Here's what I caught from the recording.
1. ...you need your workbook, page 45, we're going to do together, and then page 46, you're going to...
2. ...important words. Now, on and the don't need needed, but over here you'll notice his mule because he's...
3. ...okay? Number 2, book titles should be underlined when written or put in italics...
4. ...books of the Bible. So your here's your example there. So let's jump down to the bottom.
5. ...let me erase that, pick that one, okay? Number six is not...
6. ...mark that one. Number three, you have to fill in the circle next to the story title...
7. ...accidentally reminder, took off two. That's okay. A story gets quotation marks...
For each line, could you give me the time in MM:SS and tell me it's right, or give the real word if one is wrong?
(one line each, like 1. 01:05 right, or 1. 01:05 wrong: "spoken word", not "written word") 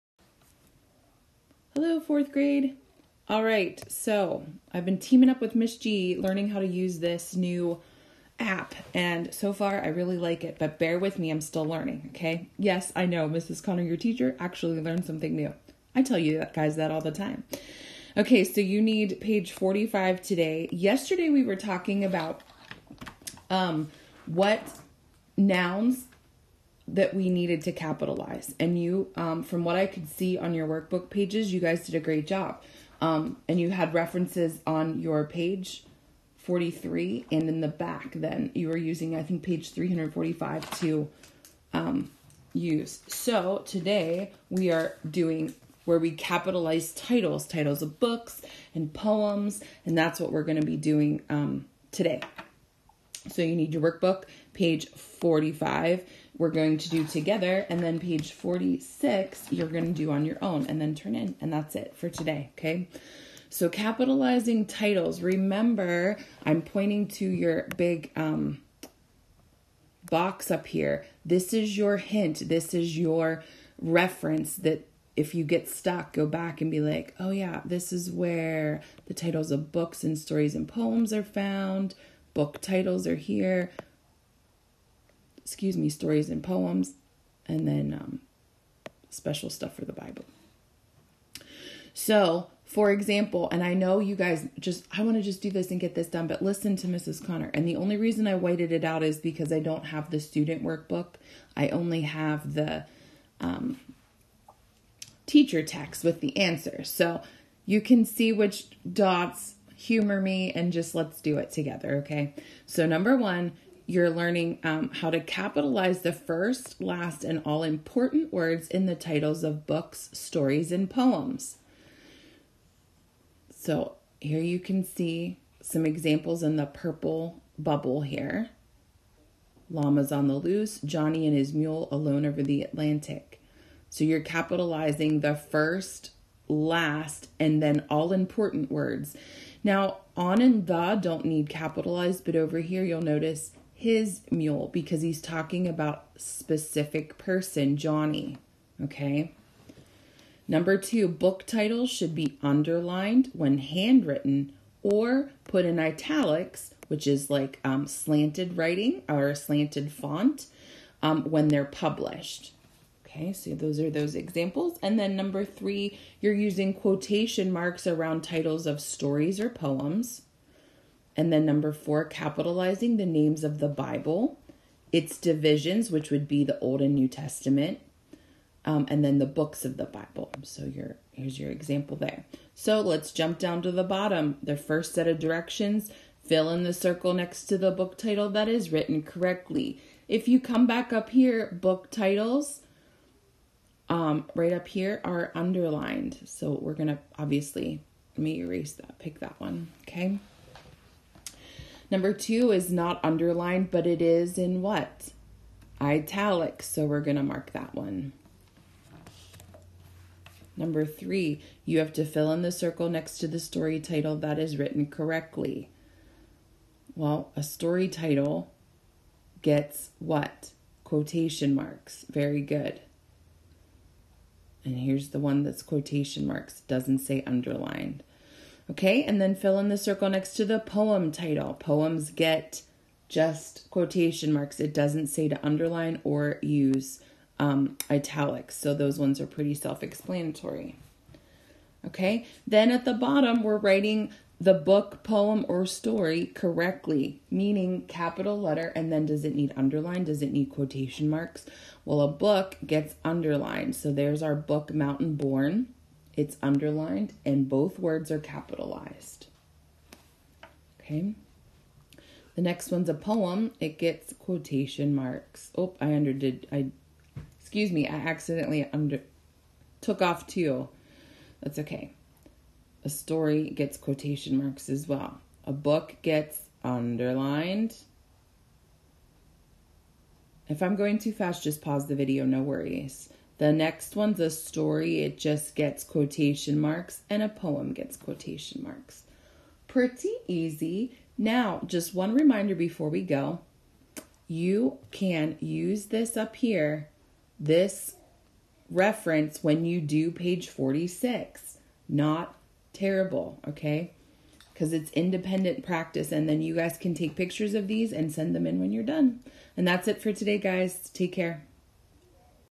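1. 00:53 right
2. 02:18 wrong: "capitalized", not "needed"
3. 02:28 wrong: "handwritten", not "written"
4. 02:59 right
5. 03:18 wrong: "two", not "six"
6. 03:27 right
7. 04:27 wrong: "under", not "reminder".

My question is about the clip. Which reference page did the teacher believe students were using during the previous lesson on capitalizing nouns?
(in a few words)
345.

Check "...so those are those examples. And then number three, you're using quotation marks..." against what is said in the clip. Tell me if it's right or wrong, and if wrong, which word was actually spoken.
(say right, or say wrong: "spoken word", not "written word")
right.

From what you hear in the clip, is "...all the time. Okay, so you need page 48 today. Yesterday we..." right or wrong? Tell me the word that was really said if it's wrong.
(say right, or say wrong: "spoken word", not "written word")
wrong: "45", not "48".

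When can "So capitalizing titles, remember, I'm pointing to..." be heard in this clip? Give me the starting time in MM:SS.
01:03.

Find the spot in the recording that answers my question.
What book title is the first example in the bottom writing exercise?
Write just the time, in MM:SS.
04:14.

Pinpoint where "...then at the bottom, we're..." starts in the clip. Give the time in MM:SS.
04:02.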